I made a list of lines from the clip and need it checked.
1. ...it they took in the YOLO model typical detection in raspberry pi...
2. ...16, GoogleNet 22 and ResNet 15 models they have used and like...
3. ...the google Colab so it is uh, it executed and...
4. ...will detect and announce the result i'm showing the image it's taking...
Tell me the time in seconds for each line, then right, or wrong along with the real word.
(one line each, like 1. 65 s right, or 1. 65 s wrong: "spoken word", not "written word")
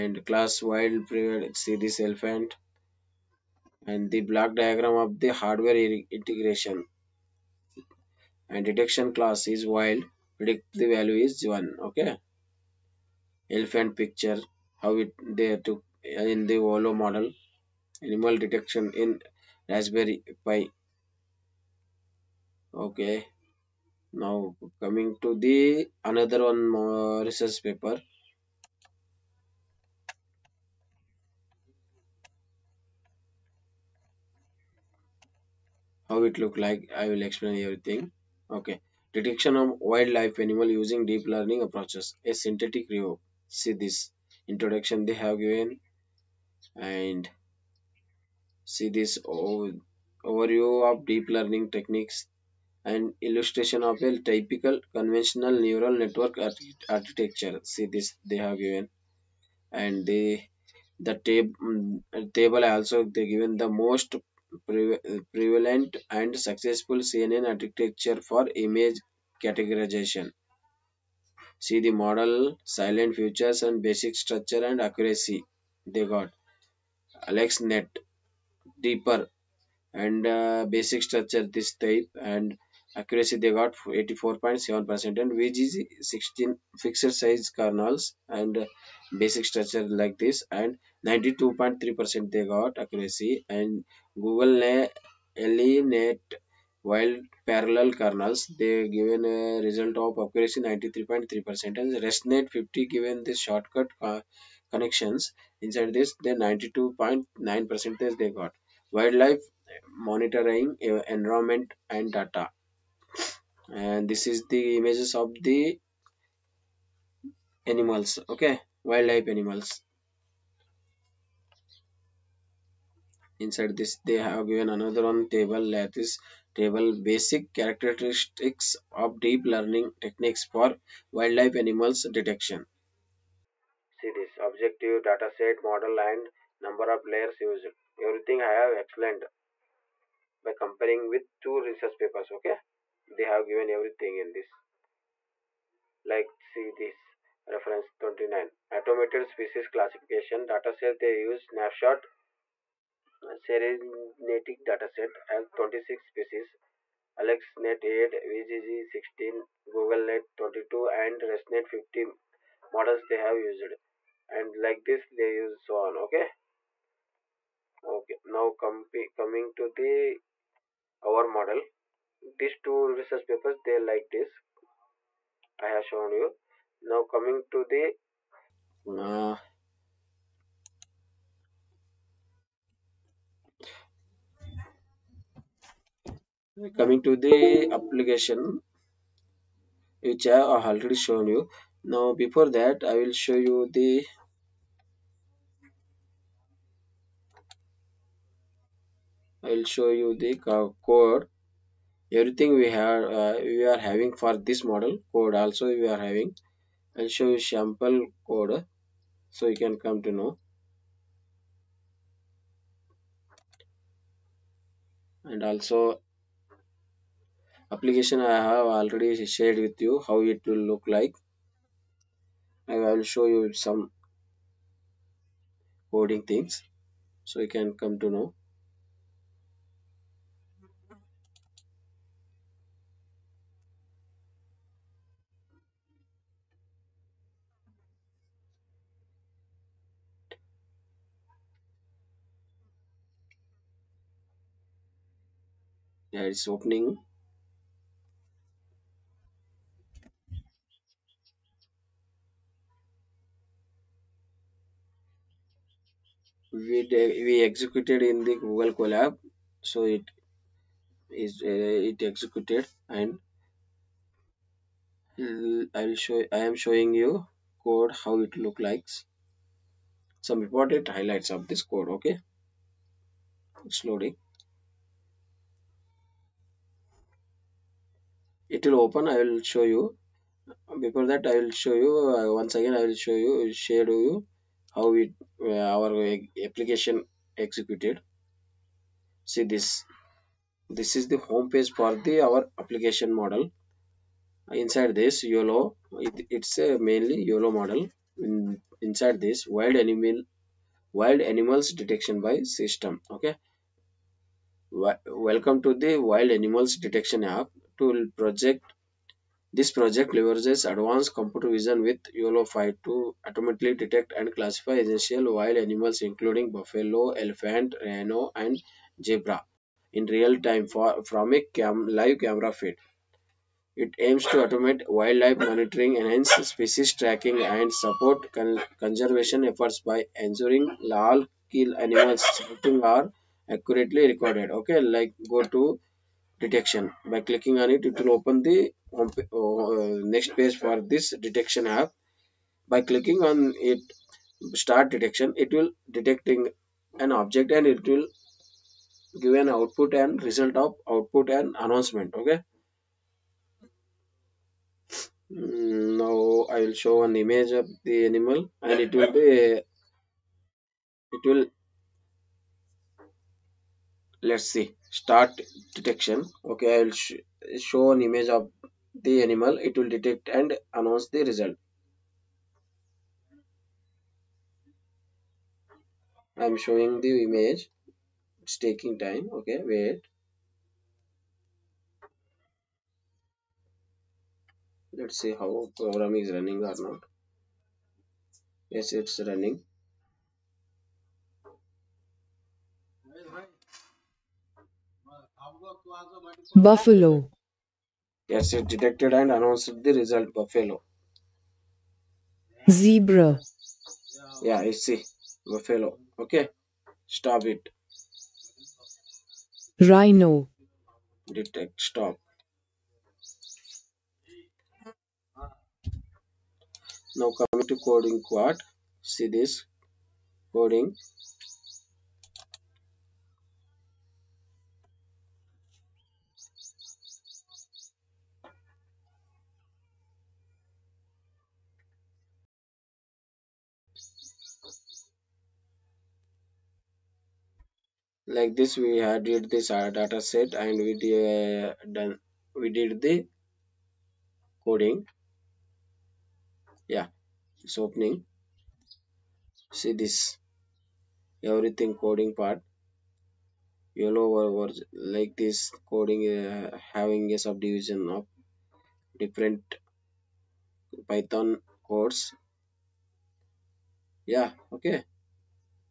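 1. 15 s wrong: "animal", not "typical"
2. 158 s right
3. 258 s right
4. 369 s right.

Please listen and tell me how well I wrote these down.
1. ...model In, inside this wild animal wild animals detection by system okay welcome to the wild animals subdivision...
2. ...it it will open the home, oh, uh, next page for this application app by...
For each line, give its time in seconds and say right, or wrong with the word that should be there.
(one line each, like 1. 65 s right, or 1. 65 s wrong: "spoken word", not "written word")
1. 297 s wrong: "detection", not "subdivision"
2. 337 s wrong: "detection", not "application".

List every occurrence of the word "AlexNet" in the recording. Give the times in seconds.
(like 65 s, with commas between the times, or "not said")
77 s, 157 s.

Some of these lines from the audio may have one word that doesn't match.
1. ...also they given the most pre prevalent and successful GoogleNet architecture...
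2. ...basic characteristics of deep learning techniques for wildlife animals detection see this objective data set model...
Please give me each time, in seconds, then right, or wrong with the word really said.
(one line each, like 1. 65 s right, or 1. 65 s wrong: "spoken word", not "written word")
1. 62 s wrong: "CNN", not "GoogleNet"
2. 127 s right.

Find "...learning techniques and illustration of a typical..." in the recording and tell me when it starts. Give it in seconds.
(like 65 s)
51 s.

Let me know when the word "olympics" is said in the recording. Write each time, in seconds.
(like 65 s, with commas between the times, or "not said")
not said.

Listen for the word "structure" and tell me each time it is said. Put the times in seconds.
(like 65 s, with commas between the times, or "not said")
74 s, 81 s, 89 s.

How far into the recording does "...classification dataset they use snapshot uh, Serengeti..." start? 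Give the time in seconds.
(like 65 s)
149 s.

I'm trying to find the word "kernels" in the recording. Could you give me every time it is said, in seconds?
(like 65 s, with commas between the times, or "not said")
87 s, 98 s.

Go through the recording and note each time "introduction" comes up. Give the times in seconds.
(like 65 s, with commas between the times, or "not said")
44 s.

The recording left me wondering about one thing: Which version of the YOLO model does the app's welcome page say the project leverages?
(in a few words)
YOLO-5.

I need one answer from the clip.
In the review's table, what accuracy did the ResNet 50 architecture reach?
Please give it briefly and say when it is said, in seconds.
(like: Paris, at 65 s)
92.9 percent, at 106 s.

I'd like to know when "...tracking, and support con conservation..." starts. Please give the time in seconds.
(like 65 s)
327 s.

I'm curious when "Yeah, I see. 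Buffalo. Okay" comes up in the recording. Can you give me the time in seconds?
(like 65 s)
404 s.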